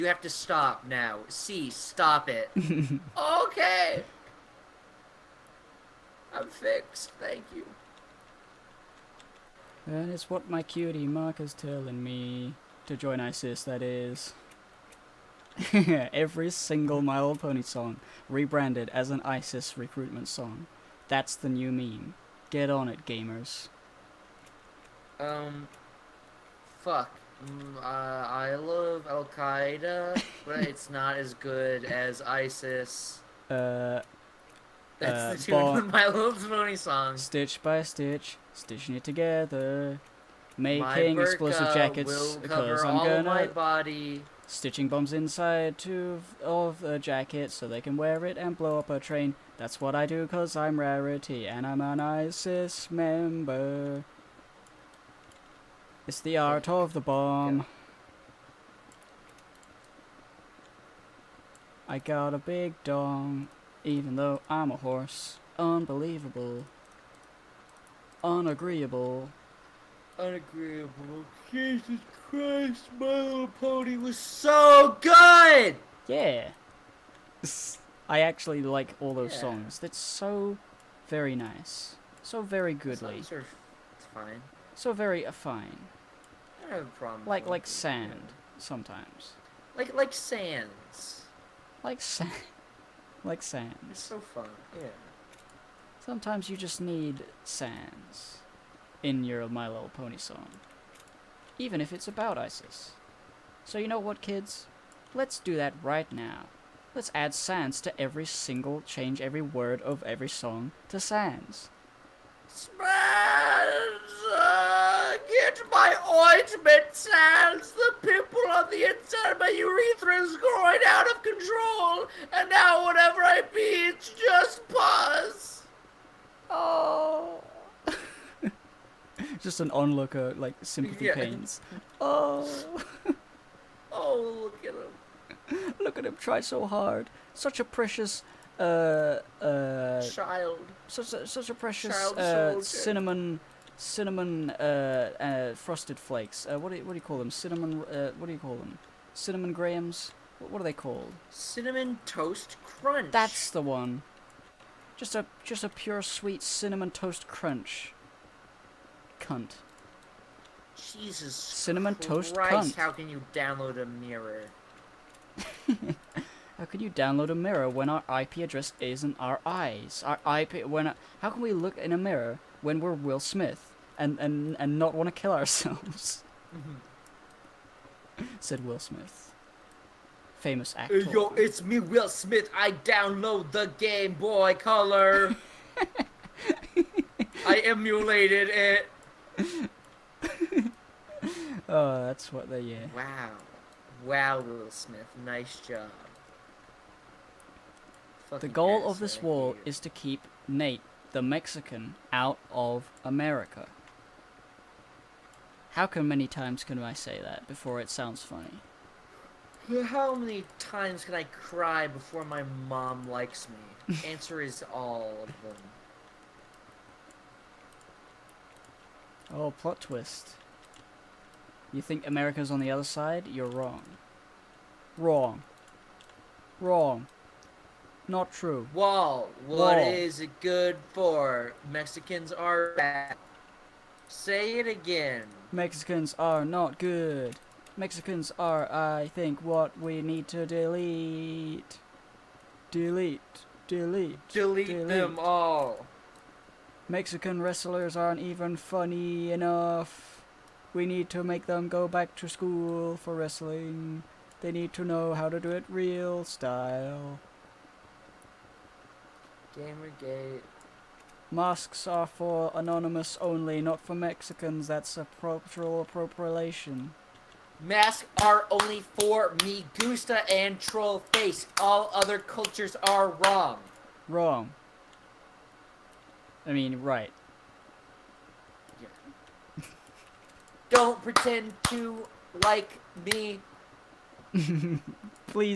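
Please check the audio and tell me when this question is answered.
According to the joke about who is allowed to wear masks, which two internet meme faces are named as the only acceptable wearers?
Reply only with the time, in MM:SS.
04:29.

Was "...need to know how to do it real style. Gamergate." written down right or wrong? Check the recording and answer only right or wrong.
right.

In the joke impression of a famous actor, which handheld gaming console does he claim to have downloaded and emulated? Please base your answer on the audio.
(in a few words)
Game Boy Color.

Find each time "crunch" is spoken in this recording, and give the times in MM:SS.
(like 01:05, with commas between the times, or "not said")
02:32, 02:37.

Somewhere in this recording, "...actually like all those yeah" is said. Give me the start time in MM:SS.
01:18.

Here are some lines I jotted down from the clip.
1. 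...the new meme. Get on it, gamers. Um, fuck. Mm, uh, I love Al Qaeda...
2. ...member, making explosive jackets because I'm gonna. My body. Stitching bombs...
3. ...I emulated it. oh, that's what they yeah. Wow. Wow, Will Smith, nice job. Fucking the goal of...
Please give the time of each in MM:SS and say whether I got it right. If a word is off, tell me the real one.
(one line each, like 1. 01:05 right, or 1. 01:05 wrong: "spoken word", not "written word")
1. 00:21 right
2. 00:39 wrong: "together", not "member"
3. 03:07 right.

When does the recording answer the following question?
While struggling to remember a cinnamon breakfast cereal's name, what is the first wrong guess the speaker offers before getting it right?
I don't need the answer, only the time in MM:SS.
02:29.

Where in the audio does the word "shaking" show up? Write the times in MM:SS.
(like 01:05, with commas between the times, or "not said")
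not said.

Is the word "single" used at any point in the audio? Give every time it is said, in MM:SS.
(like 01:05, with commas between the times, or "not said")
00:16, 01:48.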